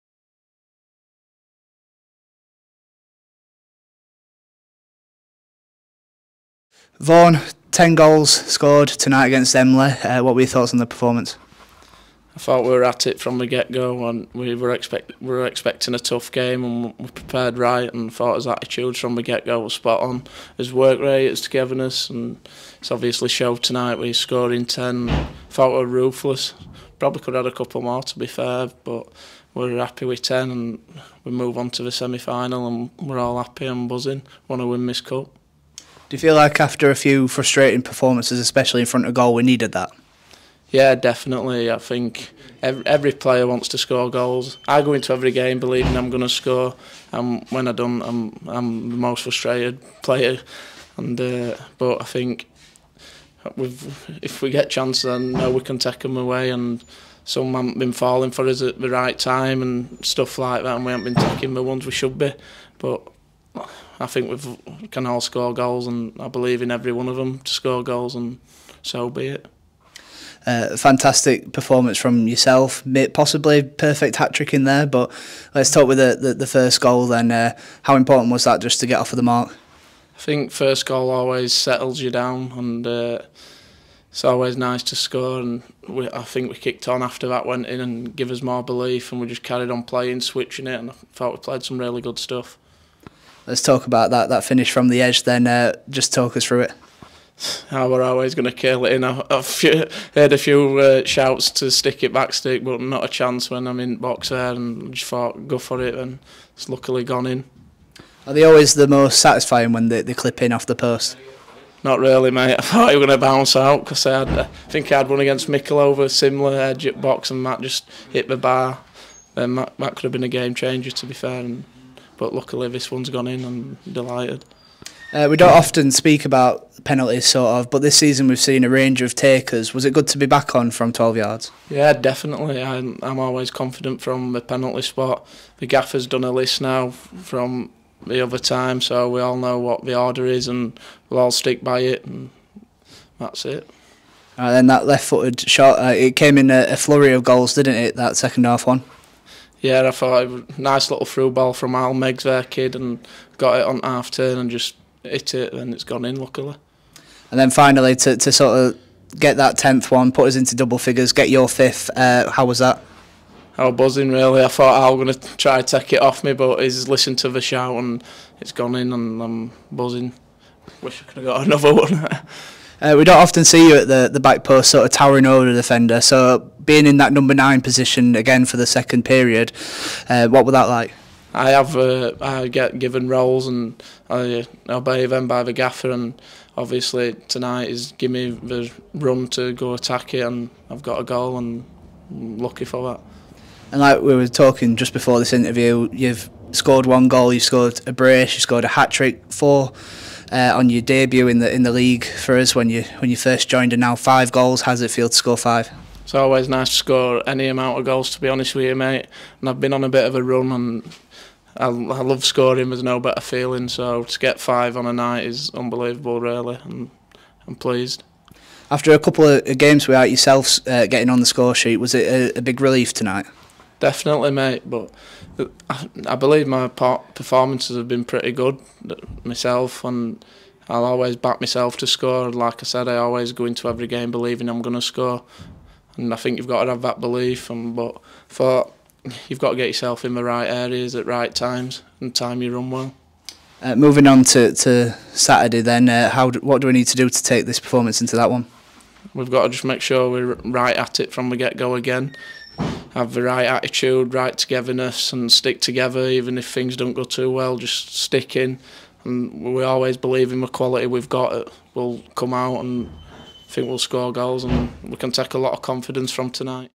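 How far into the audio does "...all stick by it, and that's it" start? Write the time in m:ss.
2:21.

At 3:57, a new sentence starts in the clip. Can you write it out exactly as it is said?
And but for thought you've got to get yourself in the right areas at right times and time you run well.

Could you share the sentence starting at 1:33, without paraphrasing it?
Let's talk about that that finish from the edge.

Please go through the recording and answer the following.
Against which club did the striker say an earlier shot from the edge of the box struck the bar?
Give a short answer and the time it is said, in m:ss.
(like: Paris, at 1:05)
Mickleover, at 1:55.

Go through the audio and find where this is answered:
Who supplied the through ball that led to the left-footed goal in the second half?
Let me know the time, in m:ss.
2:31.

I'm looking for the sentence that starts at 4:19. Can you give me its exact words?
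And we always believe in the quality we've got.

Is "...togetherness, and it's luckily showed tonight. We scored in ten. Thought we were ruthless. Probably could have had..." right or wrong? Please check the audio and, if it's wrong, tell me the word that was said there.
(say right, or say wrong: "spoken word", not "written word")
wrong: "obviously", not "luckily".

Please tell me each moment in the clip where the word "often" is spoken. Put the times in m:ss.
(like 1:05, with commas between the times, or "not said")
2:05, 2:53.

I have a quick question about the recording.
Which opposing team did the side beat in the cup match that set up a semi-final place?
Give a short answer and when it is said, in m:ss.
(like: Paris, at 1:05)
Emley, at 0:09.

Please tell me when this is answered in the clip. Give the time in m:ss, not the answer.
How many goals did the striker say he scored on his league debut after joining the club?
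3:19.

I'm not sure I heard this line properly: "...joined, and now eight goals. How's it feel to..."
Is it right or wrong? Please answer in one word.
wrong.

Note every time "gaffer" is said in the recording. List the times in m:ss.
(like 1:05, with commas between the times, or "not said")
2:15, 3:05.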